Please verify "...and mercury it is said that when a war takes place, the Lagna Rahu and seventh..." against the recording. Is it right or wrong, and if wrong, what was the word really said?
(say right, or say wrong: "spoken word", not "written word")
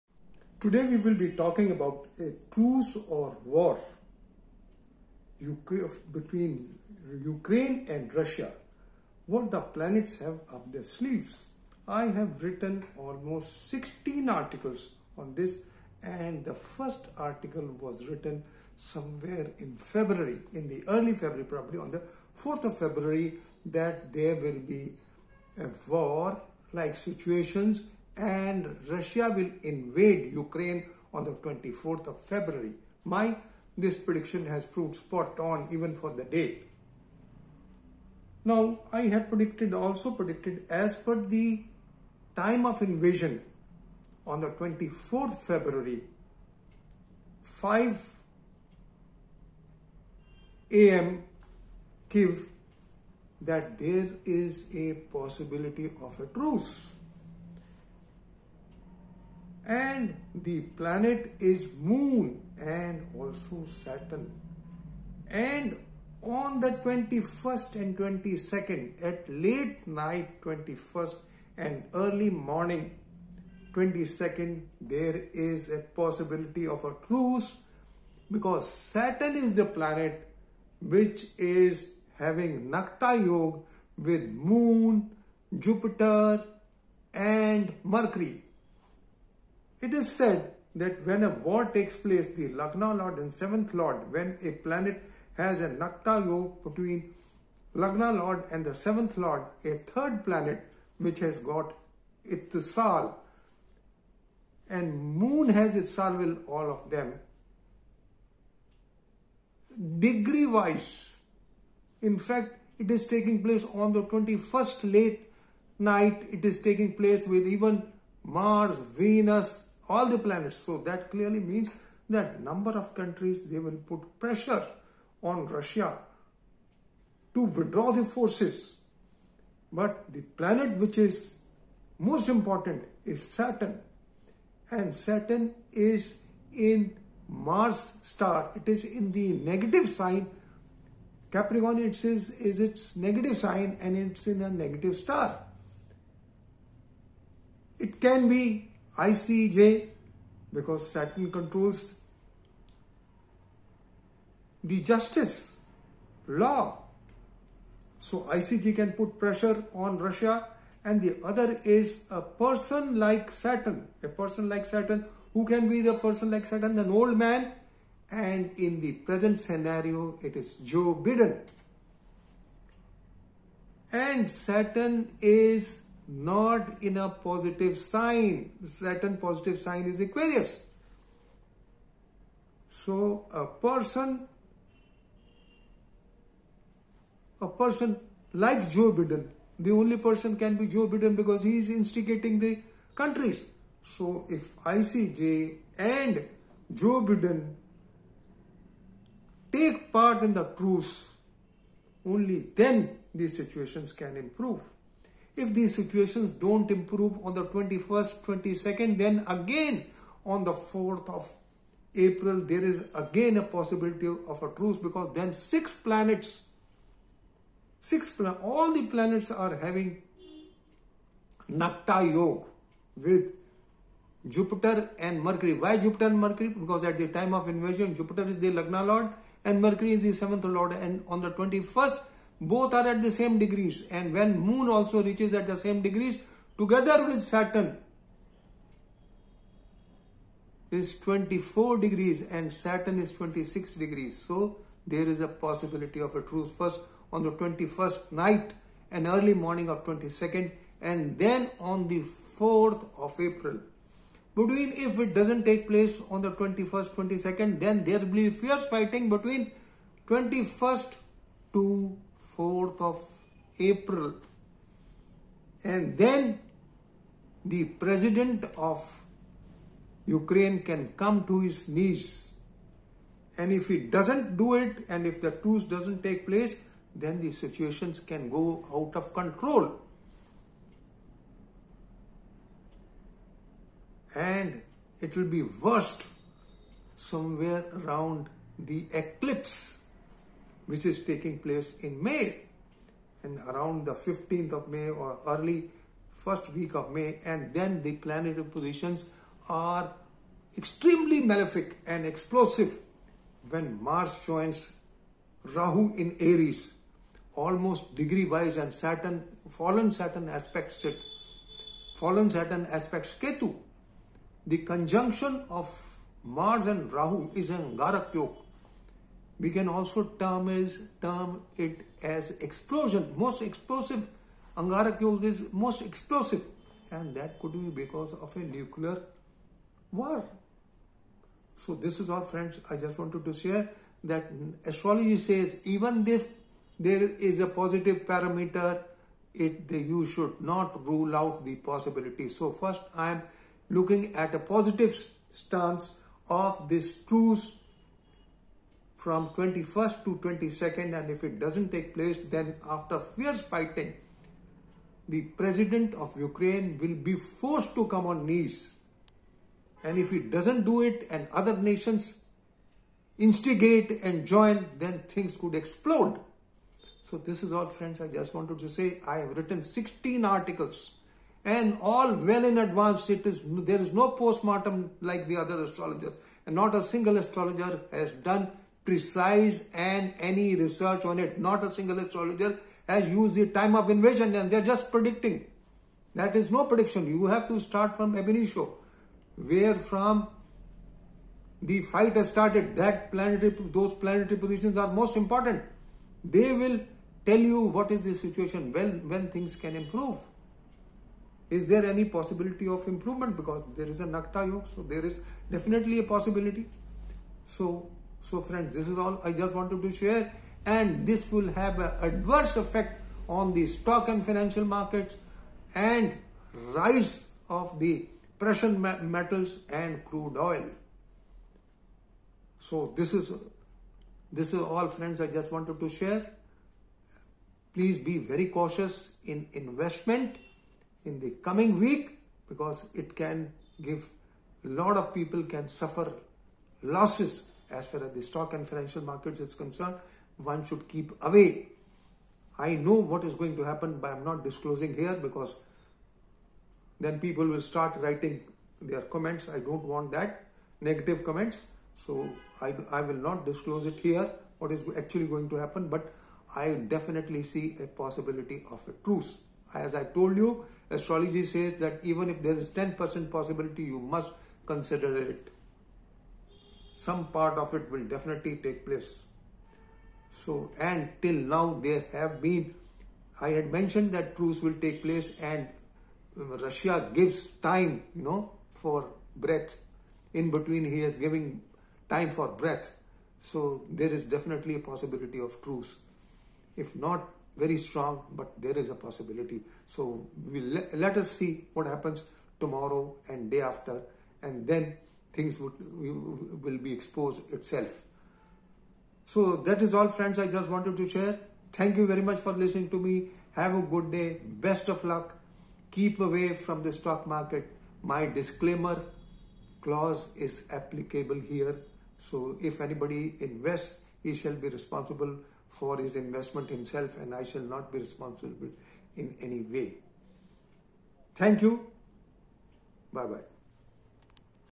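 wrong: "Lord", not "Rahu".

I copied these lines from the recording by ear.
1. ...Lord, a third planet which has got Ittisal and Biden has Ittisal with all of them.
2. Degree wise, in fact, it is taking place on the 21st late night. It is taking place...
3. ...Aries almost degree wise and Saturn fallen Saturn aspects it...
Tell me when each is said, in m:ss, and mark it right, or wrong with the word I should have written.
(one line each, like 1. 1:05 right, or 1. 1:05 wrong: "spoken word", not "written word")
1. 1:39 wrong: "Moon", not "Biden"
2. 1:49 right
3. 5:06 right.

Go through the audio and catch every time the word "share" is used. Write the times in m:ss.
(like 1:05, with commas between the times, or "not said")
5:33, 6:49, 7:05, 8:21.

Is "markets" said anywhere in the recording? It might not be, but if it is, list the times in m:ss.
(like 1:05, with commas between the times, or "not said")
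6:54, 7:19, 8:27.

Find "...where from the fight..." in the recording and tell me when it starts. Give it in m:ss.
6:29.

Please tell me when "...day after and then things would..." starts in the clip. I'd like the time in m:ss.
8:13.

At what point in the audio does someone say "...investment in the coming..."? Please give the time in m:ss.
7:09.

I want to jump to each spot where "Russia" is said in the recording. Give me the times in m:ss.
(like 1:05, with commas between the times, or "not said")
0:08, 0:28, 2:05, 2:39, 7:56.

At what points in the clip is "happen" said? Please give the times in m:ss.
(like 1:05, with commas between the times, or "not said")
7:23, 7:35, 8:11.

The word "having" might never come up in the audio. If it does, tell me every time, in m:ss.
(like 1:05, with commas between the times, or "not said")
1:22, 3:39.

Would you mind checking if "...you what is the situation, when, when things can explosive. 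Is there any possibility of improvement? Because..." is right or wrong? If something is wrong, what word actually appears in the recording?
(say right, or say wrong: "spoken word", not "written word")
wrong: "improve", not "explosive".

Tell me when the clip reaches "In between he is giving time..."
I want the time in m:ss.
8:00.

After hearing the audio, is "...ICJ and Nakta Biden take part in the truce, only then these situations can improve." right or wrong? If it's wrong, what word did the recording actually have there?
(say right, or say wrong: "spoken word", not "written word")
wrong: "Joe", not "Nakta".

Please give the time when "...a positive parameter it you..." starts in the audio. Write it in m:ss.
5:37.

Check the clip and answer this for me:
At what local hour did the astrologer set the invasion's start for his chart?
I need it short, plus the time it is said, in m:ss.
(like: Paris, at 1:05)
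5 a.m., at 0:47.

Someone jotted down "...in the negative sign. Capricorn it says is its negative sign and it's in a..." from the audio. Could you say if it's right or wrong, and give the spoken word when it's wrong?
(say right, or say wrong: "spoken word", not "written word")
right.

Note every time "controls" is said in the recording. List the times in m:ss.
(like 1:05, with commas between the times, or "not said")
2:31, 4:39.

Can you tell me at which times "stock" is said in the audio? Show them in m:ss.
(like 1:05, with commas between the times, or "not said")
6:53, 7:18, 8:26.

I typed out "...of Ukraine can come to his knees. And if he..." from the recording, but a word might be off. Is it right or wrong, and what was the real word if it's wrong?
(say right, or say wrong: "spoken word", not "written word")
right.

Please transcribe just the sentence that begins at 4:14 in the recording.
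Between if it doesn't take place on the 21st, 22nd, then there will be fierce fighting between 21st to 4th of April.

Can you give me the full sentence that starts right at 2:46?
An old man and in the present scenario it is Joe Biden.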